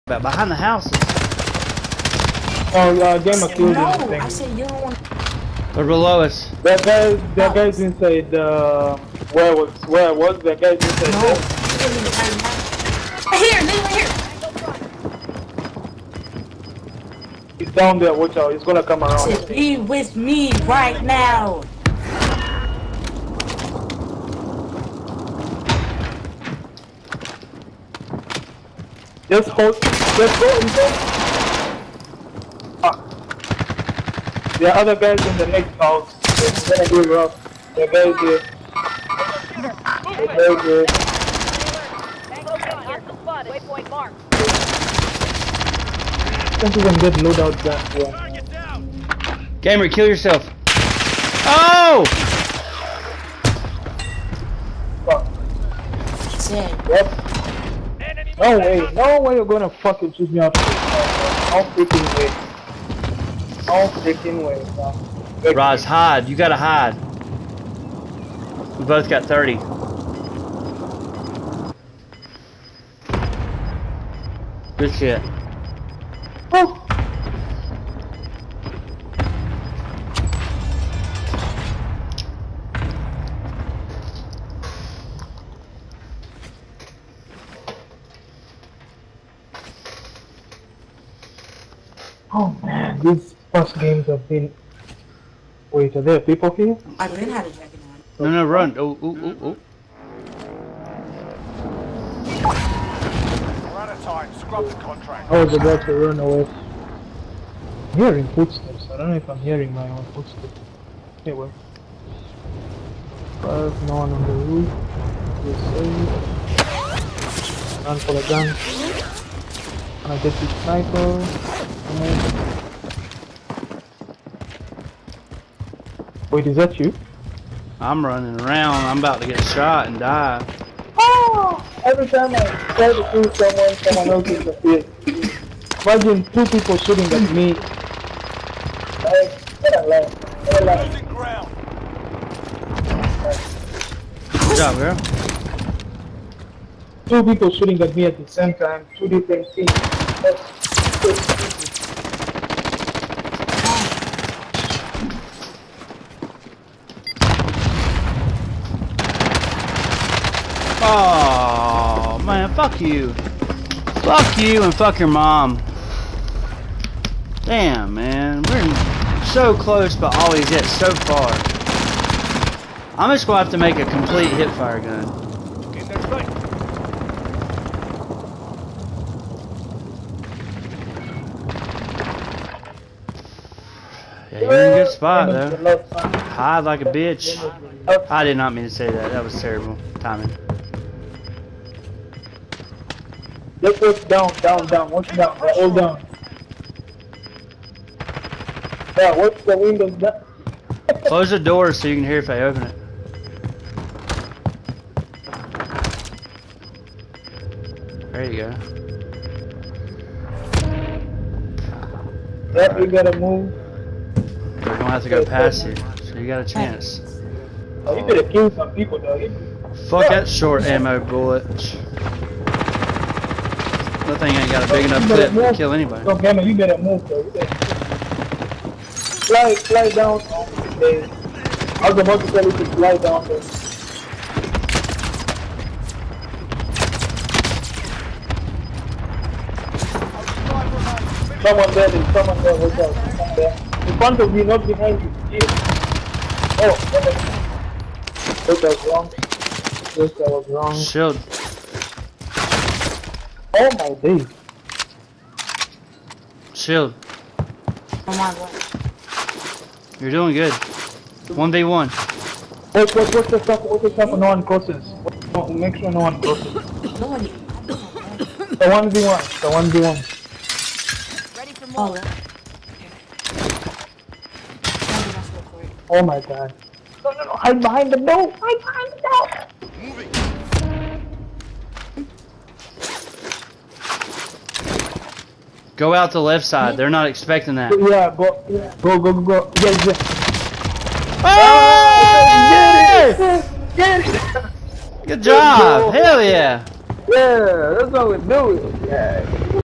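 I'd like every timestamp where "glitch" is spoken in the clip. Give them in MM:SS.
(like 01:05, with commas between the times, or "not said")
not said.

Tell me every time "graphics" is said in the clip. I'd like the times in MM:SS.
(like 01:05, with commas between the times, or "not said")
not said.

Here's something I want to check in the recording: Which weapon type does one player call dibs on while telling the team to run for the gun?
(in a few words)
sniper.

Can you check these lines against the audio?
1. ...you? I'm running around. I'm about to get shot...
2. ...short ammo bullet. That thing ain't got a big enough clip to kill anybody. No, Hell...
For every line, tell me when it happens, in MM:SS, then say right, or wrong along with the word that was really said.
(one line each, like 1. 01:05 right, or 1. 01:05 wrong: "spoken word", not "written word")
1. 02:06 right
2. 03:40 wrong: "Gamma", not "Hell".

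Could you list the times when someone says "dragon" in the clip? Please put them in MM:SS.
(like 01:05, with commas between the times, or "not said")
01:37.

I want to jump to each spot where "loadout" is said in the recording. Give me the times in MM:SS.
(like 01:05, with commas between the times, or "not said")
00:47.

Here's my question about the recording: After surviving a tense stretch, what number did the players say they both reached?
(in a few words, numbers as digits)
30.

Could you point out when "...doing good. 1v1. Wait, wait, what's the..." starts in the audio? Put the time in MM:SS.
04:20.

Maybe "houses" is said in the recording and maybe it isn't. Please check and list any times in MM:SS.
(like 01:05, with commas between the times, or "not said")
00:00, 00:35.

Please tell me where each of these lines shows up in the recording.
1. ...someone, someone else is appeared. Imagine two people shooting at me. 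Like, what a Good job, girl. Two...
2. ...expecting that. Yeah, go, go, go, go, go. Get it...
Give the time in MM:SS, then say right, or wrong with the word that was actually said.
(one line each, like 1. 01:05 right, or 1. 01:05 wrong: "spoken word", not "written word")
1. 02:13 right
2. 04:47 right.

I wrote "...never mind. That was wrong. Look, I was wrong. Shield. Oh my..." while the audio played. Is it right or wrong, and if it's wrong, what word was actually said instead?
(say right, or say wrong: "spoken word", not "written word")
right.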